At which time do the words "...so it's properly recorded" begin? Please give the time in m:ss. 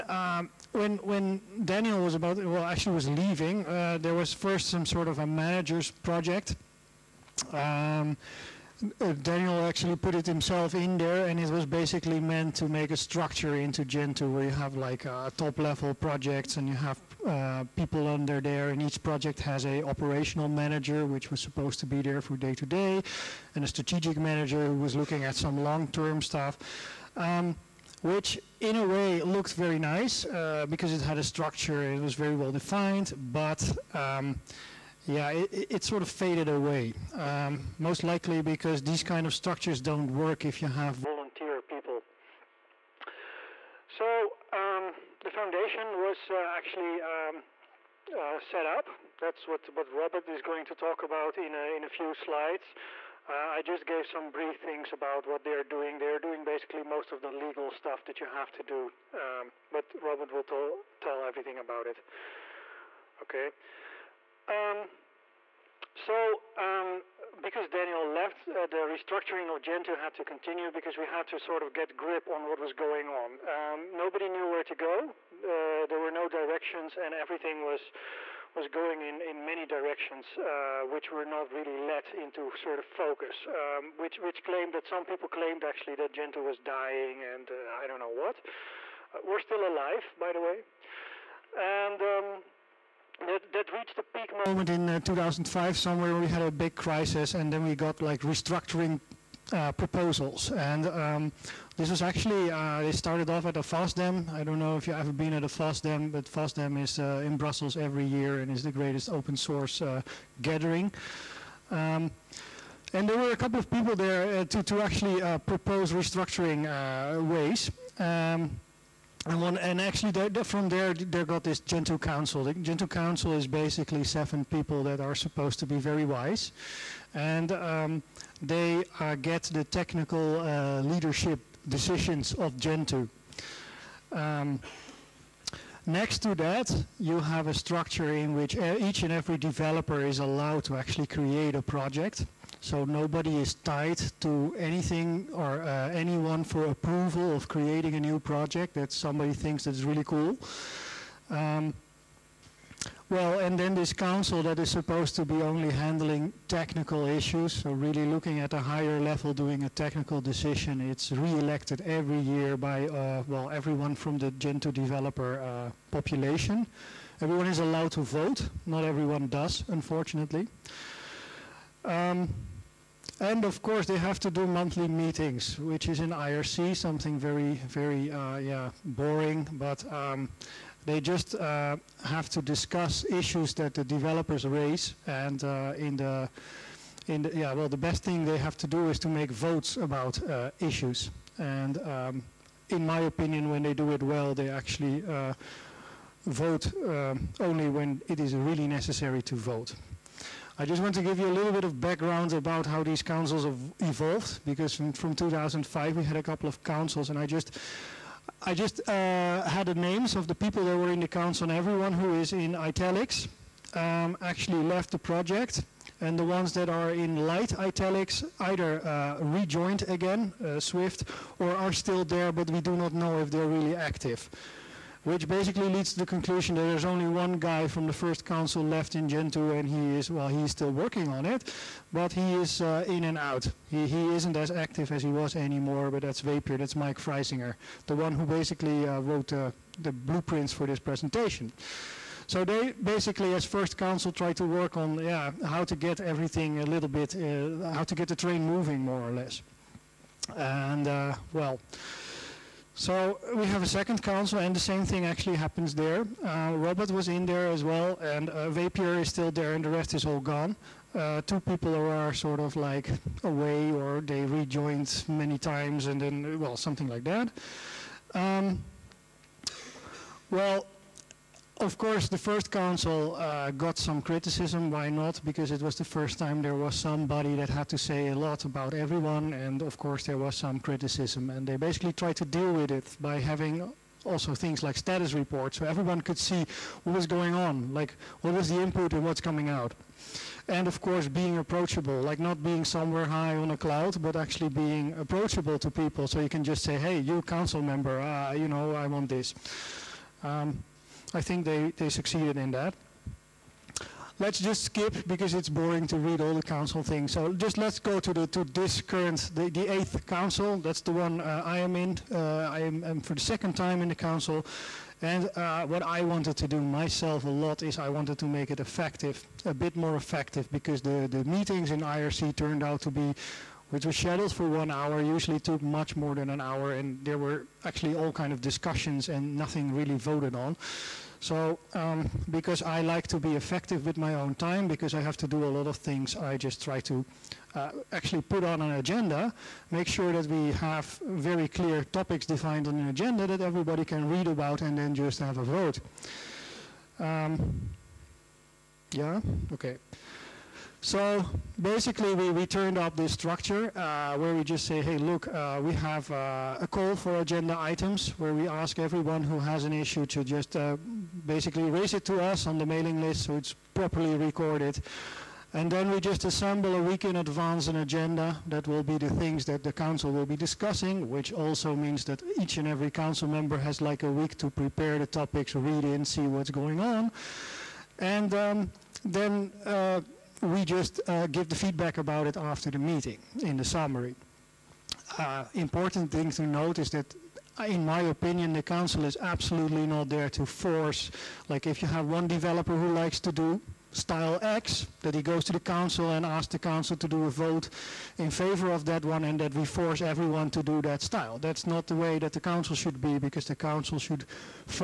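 6:03.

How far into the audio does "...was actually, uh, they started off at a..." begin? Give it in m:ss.
1:41.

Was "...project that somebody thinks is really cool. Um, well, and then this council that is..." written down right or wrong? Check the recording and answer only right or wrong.
right.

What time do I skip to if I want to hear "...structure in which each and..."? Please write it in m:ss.
2:17.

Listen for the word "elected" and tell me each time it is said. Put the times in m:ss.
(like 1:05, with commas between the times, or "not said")
2:41.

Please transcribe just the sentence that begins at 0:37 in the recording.
Um, most likely because these kind of structures don't work if you have volunteer people.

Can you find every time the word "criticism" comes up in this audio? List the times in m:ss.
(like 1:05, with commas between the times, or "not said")
4:34, 4:40.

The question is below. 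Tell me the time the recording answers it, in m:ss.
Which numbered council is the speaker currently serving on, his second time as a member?
5:09.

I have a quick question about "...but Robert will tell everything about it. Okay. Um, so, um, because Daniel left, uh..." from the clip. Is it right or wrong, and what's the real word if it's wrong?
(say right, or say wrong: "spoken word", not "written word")
right.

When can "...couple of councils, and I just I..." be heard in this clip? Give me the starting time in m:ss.
3:26.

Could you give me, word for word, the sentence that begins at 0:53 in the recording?
Uh, I just gave some brief things about what they are doing.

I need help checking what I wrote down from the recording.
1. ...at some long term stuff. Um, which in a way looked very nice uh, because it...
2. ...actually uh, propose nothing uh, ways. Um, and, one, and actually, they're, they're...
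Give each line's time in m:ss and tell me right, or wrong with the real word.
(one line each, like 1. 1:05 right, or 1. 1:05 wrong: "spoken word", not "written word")
1. 0:25 right
2. 1:54 wrong: "restructuring", not "nothing".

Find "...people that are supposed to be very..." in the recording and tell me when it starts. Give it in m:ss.
2:04.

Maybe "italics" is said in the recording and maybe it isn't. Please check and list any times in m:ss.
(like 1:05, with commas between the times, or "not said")
3:32, 3:37.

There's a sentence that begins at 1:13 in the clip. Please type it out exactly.
Um, nobody knew where to go.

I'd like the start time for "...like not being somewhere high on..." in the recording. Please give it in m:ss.
4:52.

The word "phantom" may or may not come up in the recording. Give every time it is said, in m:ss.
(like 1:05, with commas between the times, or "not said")
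not said.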